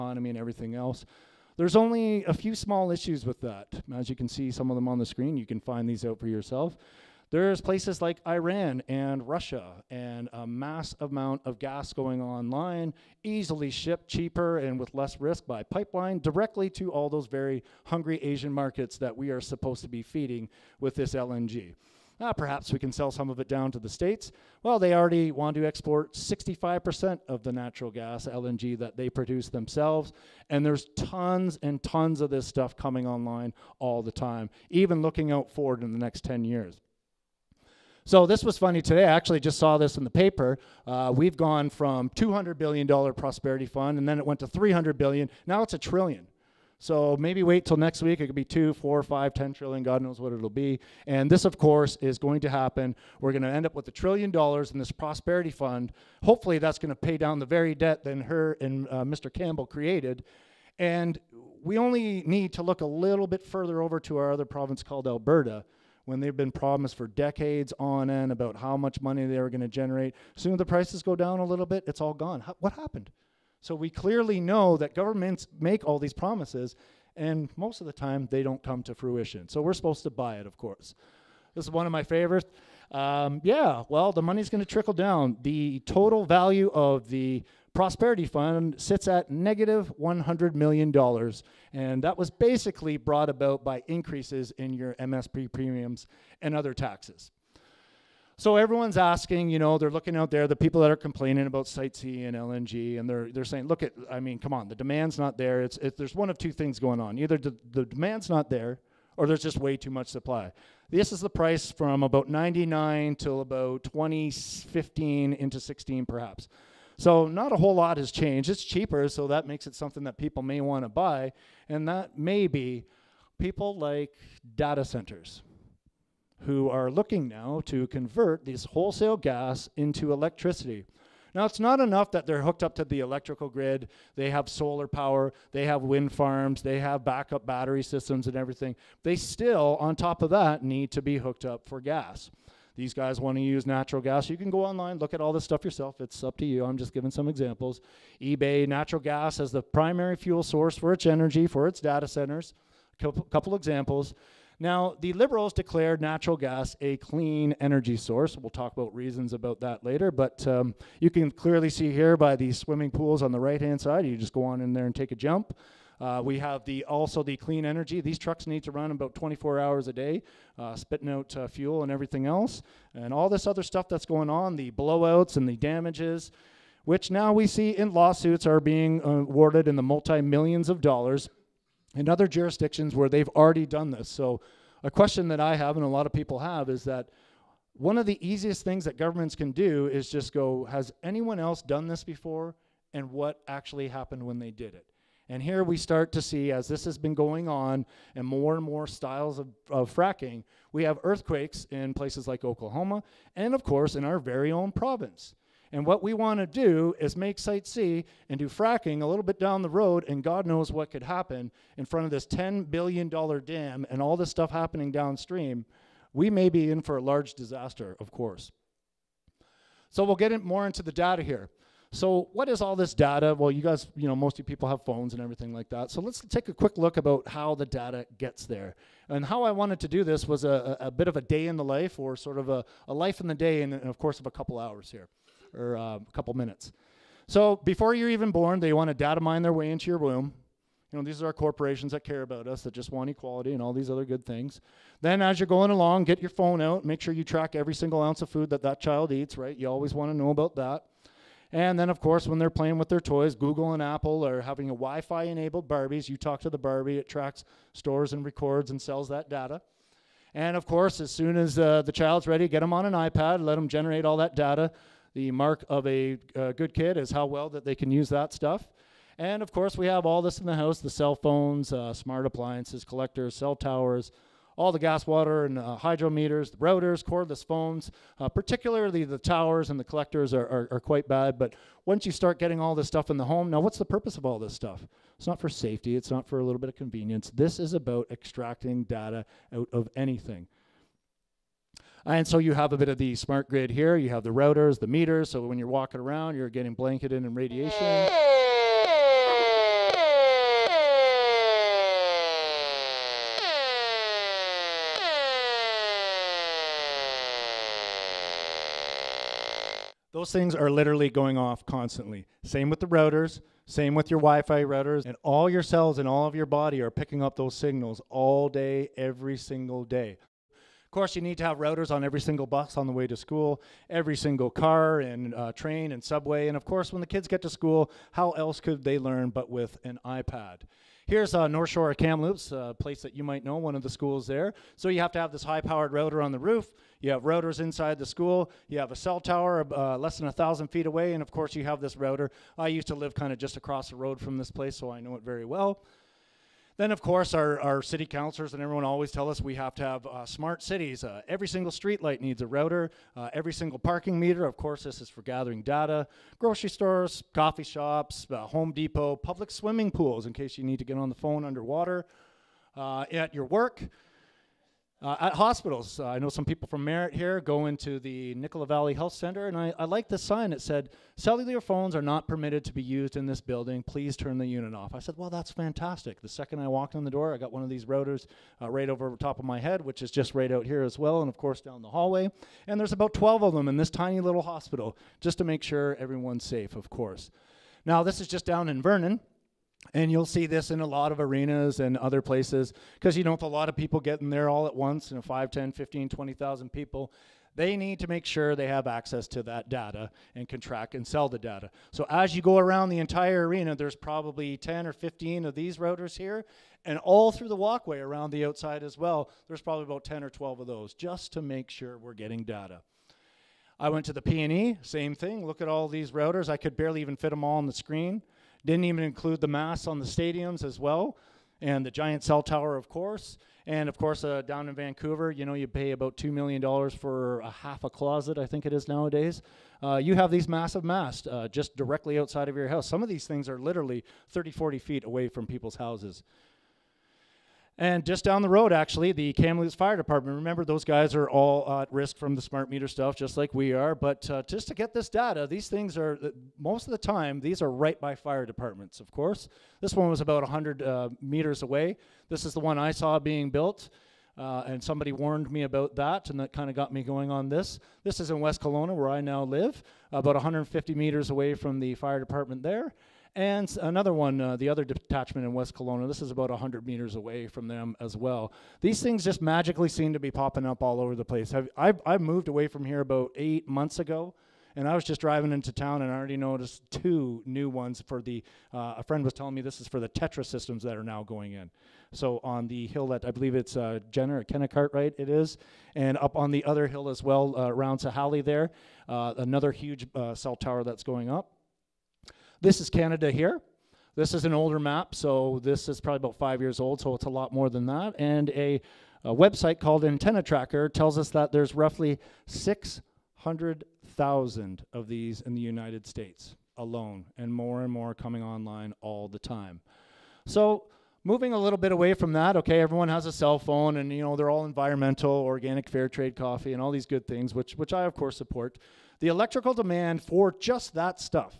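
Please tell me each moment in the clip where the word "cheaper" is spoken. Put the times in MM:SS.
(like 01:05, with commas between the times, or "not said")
00:14, 01:58.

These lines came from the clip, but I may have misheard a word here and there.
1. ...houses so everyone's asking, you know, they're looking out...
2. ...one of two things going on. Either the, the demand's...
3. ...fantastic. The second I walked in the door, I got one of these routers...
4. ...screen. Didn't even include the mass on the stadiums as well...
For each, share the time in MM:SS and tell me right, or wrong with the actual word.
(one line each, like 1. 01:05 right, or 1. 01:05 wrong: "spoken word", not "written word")
1. 01:36 wrong: "taxes", not "houses"
2. 01:46 right
3. 06:15 right
4. 06:57 right.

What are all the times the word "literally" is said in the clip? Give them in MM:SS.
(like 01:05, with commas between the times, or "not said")
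05:10, 07:13.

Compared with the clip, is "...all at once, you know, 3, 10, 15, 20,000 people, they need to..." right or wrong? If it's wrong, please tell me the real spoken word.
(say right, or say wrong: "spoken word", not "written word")
wrong: "5", not "3".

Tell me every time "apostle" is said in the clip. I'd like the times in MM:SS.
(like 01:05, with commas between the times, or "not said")
not said.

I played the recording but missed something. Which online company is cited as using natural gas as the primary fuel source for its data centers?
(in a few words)
eBay.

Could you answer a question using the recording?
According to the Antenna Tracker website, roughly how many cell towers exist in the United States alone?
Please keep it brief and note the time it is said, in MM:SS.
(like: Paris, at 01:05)
600,000, at 08:22.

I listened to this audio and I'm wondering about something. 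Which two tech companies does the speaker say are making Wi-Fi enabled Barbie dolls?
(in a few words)
Google and Apple.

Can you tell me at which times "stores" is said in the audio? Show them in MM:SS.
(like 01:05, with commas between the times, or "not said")
04:17, 05:56.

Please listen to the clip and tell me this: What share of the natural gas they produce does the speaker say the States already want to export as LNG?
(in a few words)
65%.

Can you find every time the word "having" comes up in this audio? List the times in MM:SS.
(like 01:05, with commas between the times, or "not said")
04:14.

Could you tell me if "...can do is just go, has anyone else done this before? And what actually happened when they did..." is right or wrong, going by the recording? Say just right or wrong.
right.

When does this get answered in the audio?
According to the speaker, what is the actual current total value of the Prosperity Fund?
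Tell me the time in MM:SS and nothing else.
01:29.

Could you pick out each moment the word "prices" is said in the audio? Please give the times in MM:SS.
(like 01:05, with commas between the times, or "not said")
01:10, 01:51.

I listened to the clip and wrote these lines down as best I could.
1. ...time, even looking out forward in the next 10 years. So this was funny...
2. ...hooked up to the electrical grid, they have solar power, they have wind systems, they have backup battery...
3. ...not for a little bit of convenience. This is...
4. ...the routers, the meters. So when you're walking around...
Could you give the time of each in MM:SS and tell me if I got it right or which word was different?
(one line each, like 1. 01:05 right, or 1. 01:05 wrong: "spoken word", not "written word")
1. 00:34 right
2. 02:12 wrong: "farms", not "systems"
3. 04:46 right
4. 04:54 right.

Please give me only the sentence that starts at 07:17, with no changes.
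And just down the road, actually, the Kamloops Fire Department.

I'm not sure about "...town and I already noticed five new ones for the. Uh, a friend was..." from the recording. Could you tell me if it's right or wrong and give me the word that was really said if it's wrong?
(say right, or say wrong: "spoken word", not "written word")
wrong: "two", not "five".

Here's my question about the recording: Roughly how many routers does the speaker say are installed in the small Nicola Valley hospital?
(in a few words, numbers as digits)
12.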